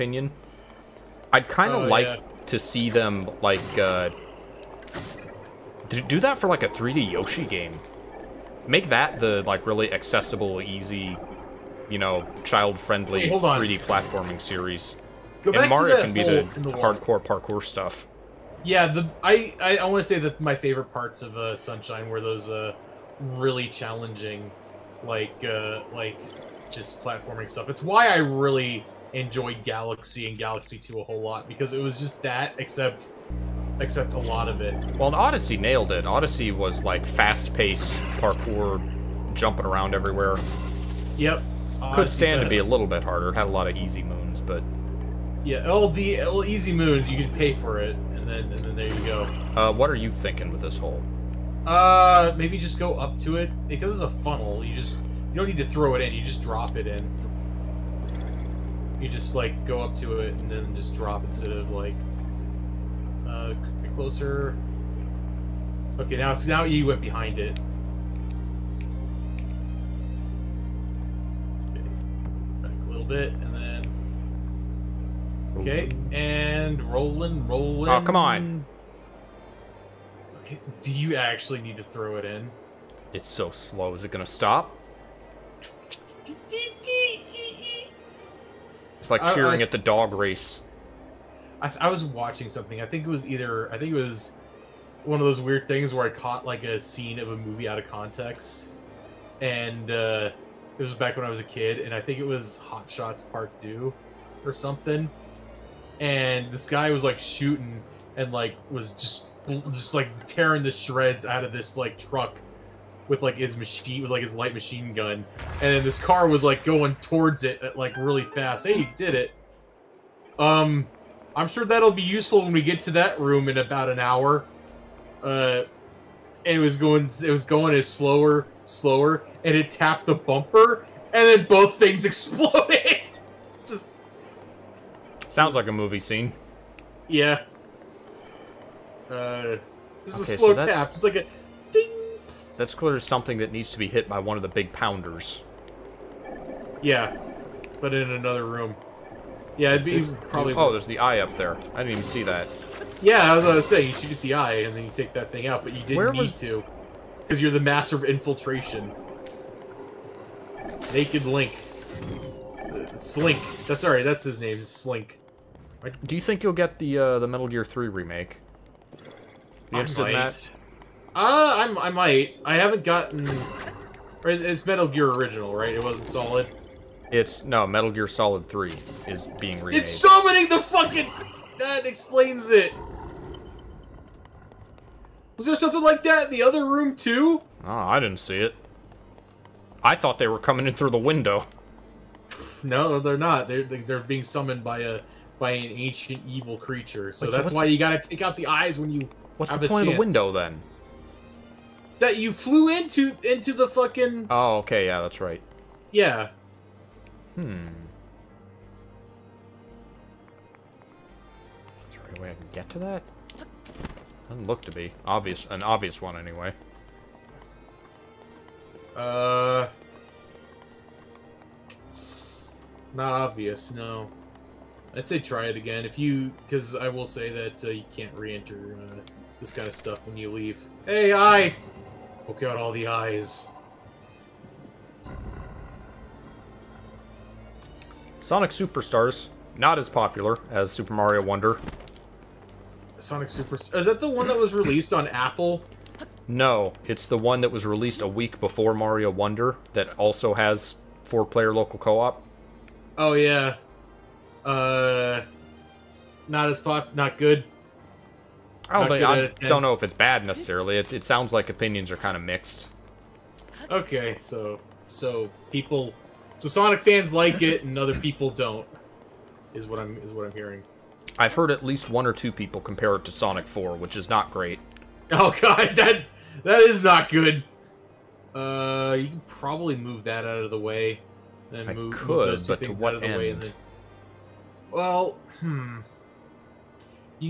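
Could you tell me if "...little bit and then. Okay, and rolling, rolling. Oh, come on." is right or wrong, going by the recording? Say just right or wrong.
right.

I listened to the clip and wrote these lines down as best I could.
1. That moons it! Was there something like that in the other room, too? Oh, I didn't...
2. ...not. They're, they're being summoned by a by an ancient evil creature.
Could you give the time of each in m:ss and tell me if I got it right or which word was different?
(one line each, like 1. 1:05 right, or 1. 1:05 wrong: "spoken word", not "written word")
1. 3:01 wrong: "explains", not "moons"
2. 3:13 right.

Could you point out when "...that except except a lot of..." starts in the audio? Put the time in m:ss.
0:32.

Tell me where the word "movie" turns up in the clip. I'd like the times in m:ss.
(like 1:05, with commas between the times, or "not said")
1:37, 2:15.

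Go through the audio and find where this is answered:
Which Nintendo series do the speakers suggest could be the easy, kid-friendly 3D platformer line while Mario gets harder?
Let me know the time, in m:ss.
0:07.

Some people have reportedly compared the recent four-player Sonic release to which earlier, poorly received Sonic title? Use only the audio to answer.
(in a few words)
Sonic 4.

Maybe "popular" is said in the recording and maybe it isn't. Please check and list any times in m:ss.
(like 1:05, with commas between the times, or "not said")
3:59.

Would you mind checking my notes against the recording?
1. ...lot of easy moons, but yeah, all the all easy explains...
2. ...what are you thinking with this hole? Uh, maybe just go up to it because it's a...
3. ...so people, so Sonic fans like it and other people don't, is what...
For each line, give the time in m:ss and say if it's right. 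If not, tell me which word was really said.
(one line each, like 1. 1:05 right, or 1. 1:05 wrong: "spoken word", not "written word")
1. 0:43 wrong: "moons", not "explains"
2. 0:49 right
3. 4:24 right.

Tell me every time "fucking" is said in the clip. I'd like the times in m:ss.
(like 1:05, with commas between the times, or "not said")
3:00, 3:23.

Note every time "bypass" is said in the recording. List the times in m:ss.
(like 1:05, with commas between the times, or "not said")
not said.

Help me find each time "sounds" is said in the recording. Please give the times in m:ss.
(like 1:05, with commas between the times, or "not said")
2:15, 4:21.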